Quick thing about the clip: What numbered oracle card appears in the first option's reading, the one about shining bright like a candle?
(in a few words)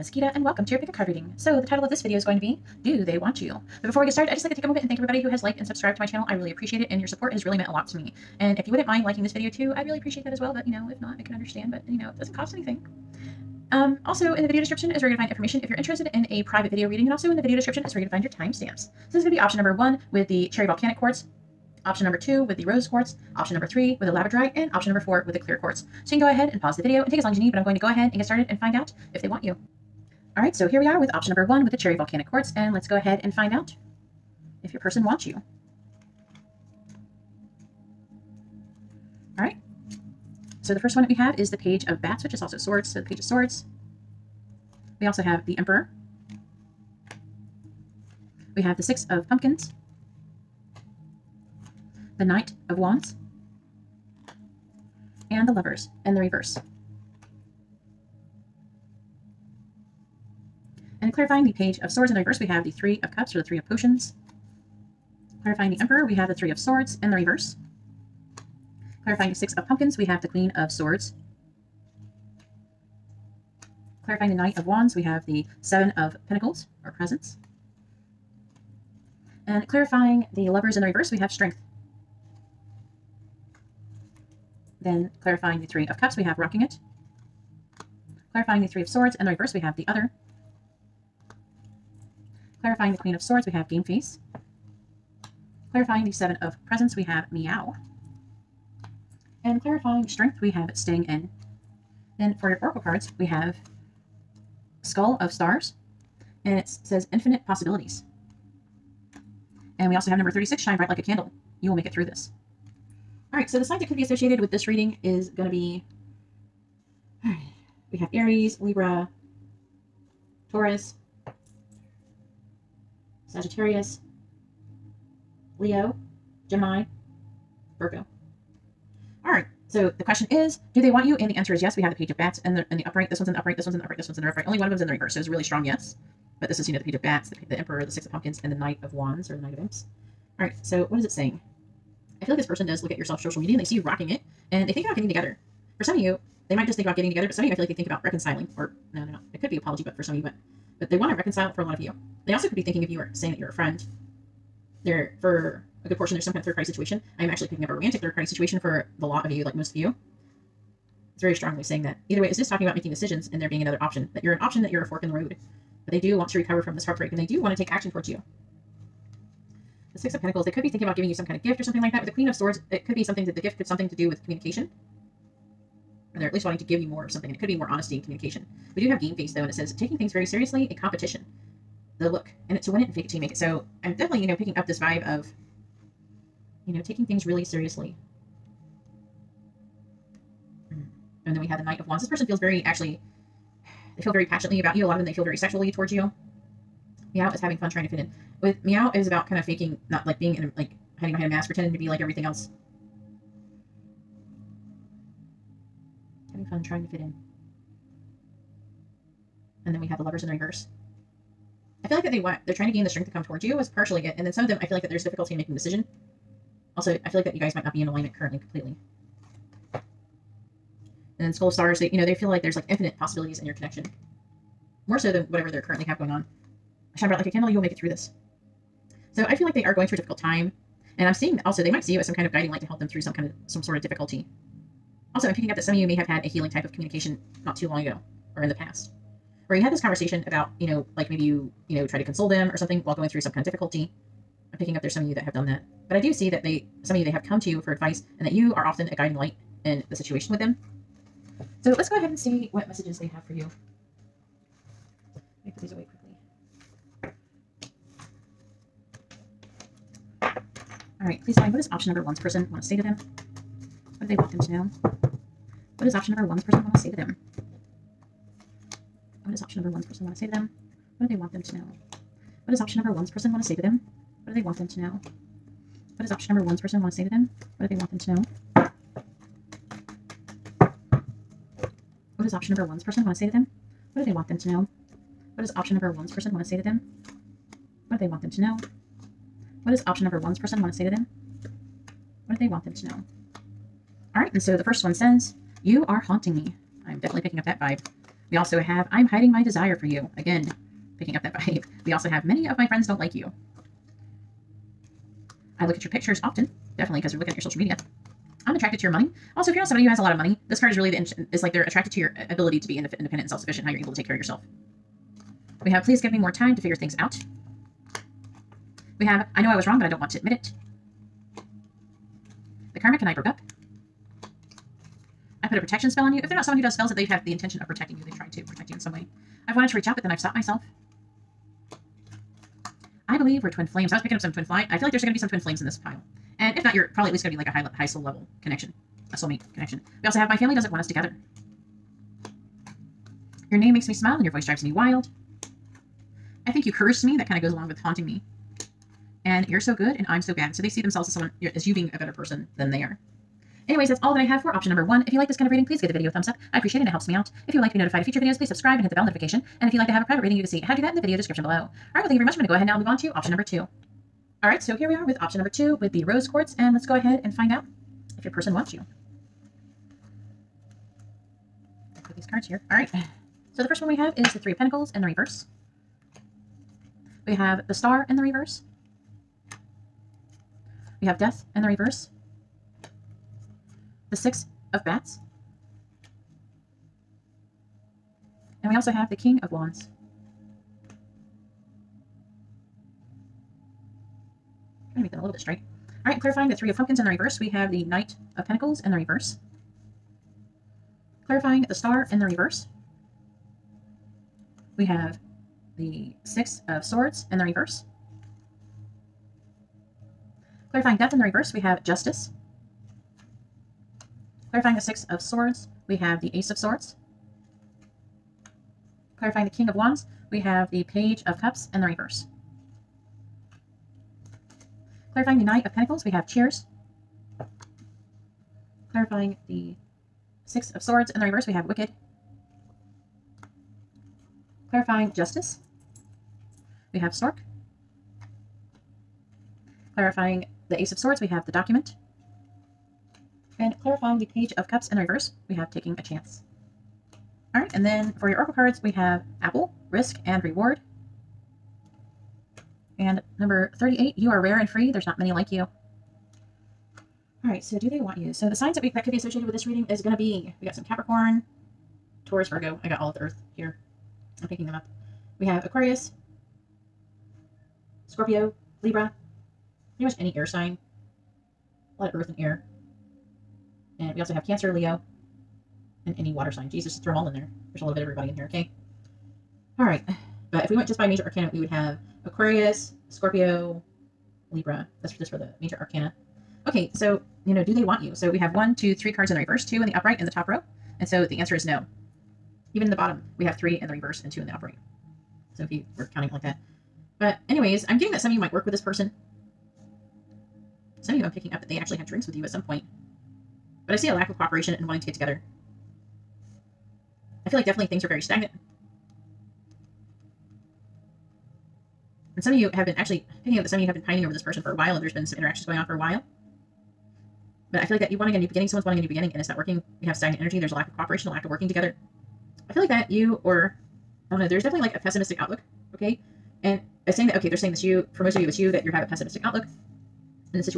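36.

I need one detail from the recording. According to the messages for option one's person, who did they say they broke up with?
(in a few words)
The karmic.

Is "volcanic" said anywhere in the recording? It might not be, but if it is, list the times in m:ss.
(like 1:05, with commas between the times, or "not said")
0:20, 0:31.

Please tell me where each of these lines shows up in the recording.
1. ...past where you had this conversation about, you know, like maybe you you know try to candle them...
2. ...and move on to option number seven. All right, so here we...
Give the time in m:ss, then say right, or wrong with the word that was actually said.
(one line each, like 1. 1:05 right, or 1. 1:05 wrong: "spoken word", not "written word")
1. 3:58 wrong: "console", not "candle"
2. 6:02 wrong: "two", not "seven".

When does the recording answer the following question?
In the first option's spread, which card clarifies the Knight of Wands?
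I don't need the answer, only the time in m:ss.
1:15.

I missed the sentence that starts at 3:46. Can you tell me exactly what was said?
I shine bright like a candle, you will make it through this.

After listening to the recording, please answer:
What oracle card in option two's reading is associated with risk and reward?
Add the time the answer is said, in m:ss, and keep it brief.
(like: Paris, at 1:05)
Apple, at 7:29.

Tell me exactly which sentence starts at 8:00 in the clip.
But if we went just by major arcana, we would have Aquarius, Scorpio, Libra.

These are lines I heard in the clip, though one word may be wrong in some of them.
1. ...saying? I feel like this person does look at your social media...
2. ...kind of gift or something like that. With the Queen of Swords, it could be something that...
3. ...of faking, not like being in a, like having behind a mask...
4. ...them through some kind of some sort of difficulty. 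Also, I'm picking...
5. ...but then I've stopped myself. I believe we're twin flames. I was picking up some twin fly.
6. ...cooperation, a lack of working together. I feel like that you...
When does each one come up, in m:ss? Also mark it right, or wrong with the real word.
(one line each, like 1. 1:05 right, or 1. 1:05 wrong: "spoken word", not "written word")
1. 2:21 right
2. 2:51 right
3. 3:19 wrong: "hiding", not "having"
4. 3:52 right
5. 5:29 right
6. 8:40 right.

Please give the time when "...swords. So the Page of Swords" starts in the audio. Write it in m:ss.
0:42.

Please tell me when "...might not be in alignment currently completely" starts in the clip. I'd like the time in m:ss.
3:37.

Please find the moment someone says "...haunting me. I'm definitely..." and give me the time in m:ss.
4:55.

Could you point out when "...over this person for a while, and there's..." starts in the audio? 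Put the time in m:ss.
8:34.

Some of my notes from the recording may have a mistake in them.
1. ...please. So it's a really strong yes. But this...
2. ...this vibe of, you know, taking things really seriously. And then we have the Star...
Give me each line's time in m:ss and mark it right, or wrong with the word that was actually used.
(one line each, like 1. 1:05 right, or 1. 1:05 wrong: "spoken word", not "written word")
1. 2:14 wrong: "reverse", not "please"
2. 3:04 wrong: "Knight", not "Star".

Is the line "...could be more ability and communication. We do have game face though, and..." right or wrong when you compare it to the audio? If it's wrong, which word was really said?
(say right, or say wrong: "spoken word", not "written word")
wrong: "honesty", not "ability".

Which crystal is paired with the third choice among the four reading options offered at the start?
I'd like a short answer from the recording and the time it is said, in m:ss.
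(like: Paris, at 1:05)
Labradorite, at 0:24.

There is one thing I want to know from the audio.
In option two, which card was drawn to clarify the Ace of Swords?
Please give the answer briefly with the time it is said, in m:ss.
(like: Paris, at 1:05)
The Document, at 7:21.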